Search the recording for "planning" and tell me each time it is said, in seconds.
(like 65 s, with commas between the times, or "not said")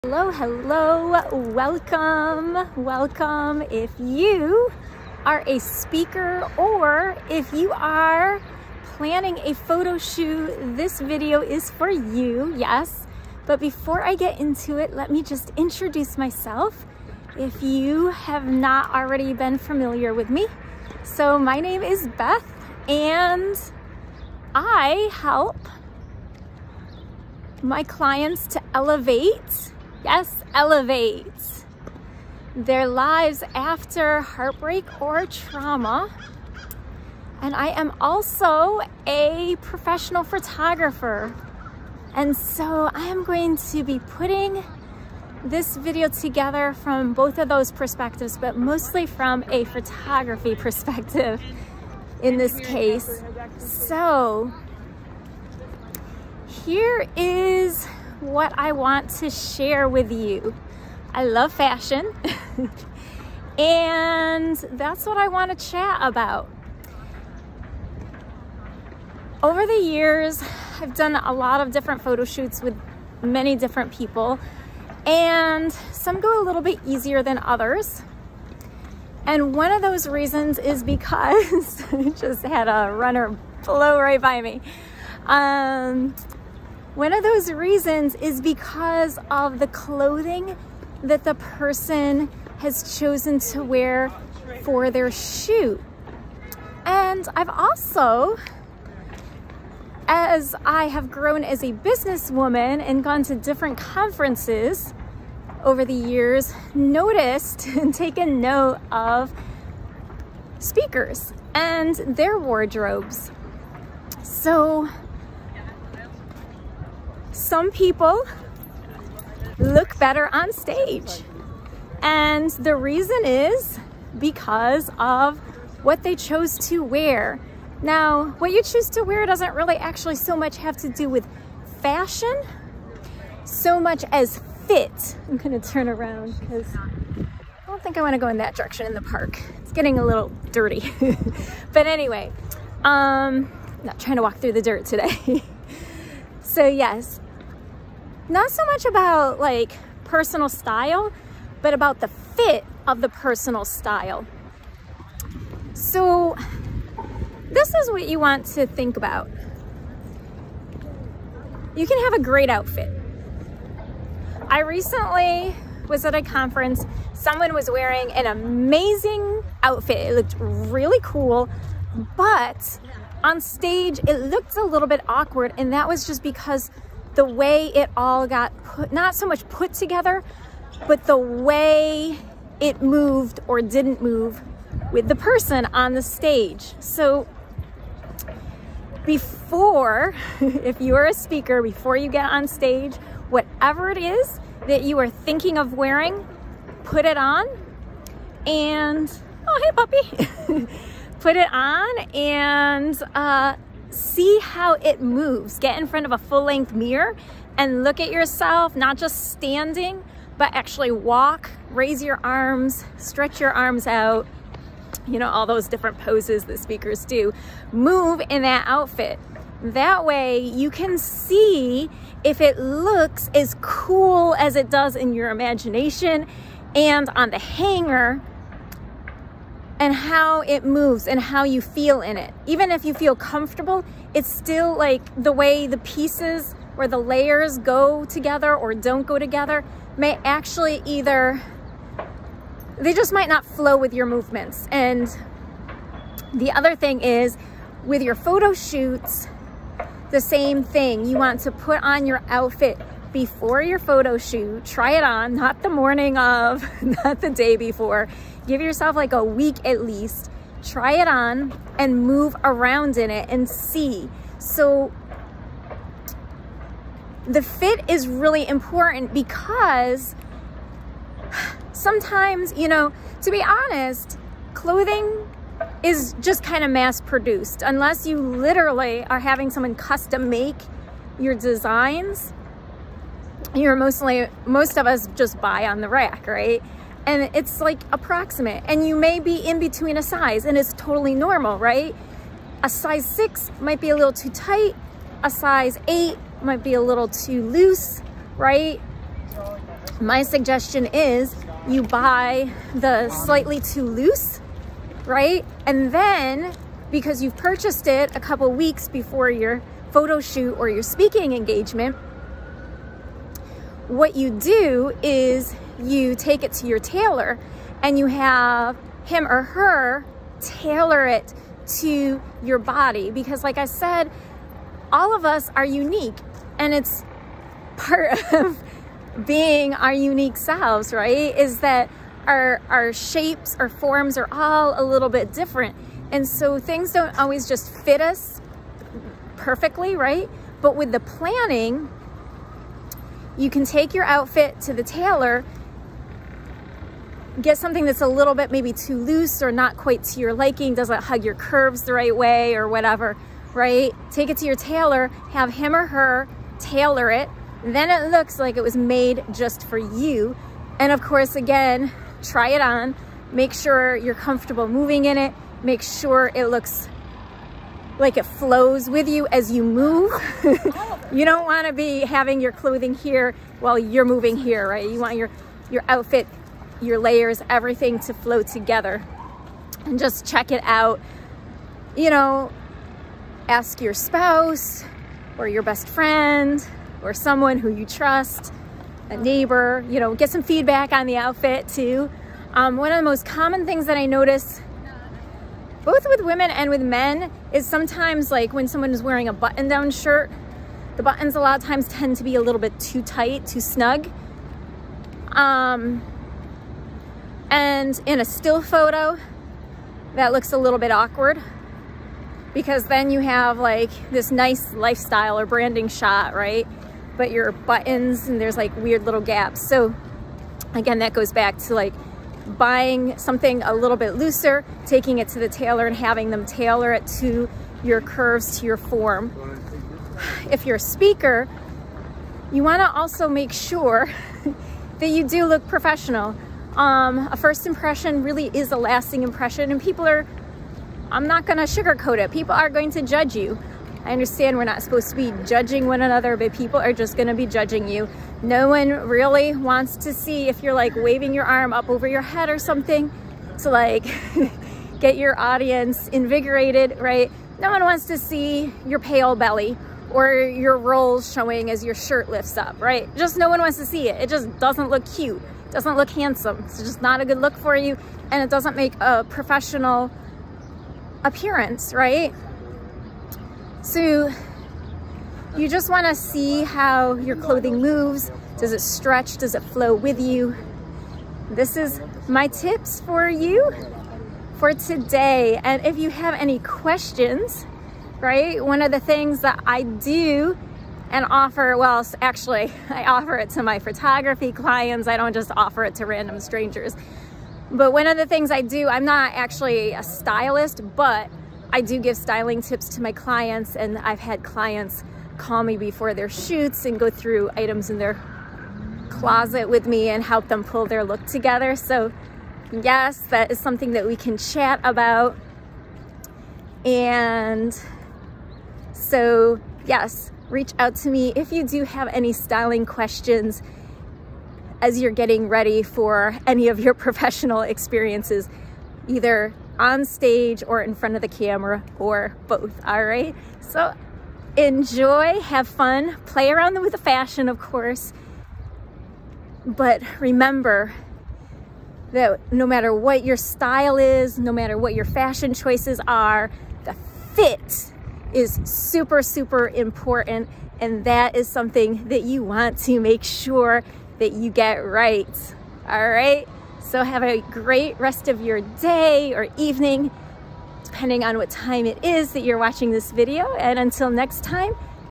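8 s, 340 s.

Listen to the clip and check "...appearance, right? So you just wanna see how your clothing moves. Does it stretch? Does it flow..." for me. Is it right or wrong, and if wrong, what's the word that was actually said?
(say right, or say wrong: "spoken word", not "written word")
right.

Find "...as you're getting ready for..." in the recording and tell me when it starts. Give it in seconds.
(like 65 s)
524 s.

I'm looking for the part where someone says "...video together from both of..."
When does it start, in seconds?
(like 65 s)
45 s.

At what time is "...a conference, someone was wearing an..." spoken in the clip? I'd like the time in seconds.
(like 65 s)
166 s.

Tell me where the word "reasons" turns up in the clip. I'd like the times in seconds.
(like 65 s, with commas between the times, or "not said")
80 s, 87 s, 122 s.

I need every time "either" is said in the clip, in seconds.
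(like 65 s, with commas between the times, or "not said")
240 s, 529 s.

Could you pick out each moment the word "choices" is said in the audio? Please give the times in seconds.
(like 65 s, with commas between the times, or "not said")
545 s.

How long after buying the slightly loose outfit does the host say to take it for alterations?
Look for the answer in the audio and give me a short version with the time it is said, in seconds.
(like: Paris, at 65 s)
A couple weeks, at 308 s.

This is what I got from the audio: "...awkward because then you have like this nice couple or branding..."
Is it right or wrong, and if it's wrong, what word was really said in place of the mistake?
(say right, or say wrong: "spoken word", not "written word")
wrong: "lifestyle", not "couple".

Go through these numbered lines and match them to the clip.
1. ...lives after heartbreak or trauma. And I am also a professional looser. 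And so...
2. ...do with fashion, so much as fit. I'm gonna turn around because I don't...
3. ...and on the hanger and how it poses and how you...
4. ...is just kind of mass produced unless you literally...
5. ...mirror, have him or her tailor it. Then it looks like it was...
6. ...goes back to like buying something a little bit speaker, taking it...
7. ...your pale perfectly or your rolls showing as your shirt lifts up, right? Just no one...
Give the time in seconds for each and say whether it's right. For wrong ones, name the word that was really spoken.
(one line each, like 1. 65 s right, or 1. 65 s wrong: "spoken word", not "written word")
1. 32 s wrong: "photographer", not "looser"
2. 130 s right
3. 226 s wrong: "moves", not "poses"
4. 275 s right
5. 354 s wrong: "tailor", not "mirror"
6. 421 s wrong: "looser", not "speaker"
7. 458 s wrong: "belly", not "perfectly".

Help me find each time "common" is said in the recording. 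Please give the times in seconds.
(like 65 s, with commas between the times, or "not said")
393 s.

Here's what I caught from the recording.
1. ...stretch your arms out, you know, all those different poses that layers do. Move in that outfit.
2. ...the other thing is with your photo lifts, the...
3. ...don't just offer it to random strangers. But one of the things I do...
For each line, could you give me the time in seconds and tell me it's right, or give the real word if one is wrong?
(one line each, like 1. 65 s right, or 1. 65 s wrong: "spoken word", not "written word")
1. 212 s wrong: "speakers", not "layers"
2. 246 s wrong: "shoots", not "lifts"
3. 495 s right.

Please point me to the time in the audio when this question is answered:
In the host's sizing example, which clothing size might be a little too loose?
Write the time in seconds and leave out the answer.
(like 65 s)
295 s.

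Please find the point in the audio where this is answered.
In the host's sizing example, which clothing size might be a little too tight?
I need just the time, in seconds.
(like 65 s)
292 s.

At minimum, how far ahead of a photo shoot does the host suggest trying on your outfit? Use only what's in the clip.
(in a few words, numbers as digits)
A week.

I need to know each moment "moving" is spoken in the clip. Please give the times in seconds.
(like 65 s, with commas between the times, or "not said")
364 s, 374 s.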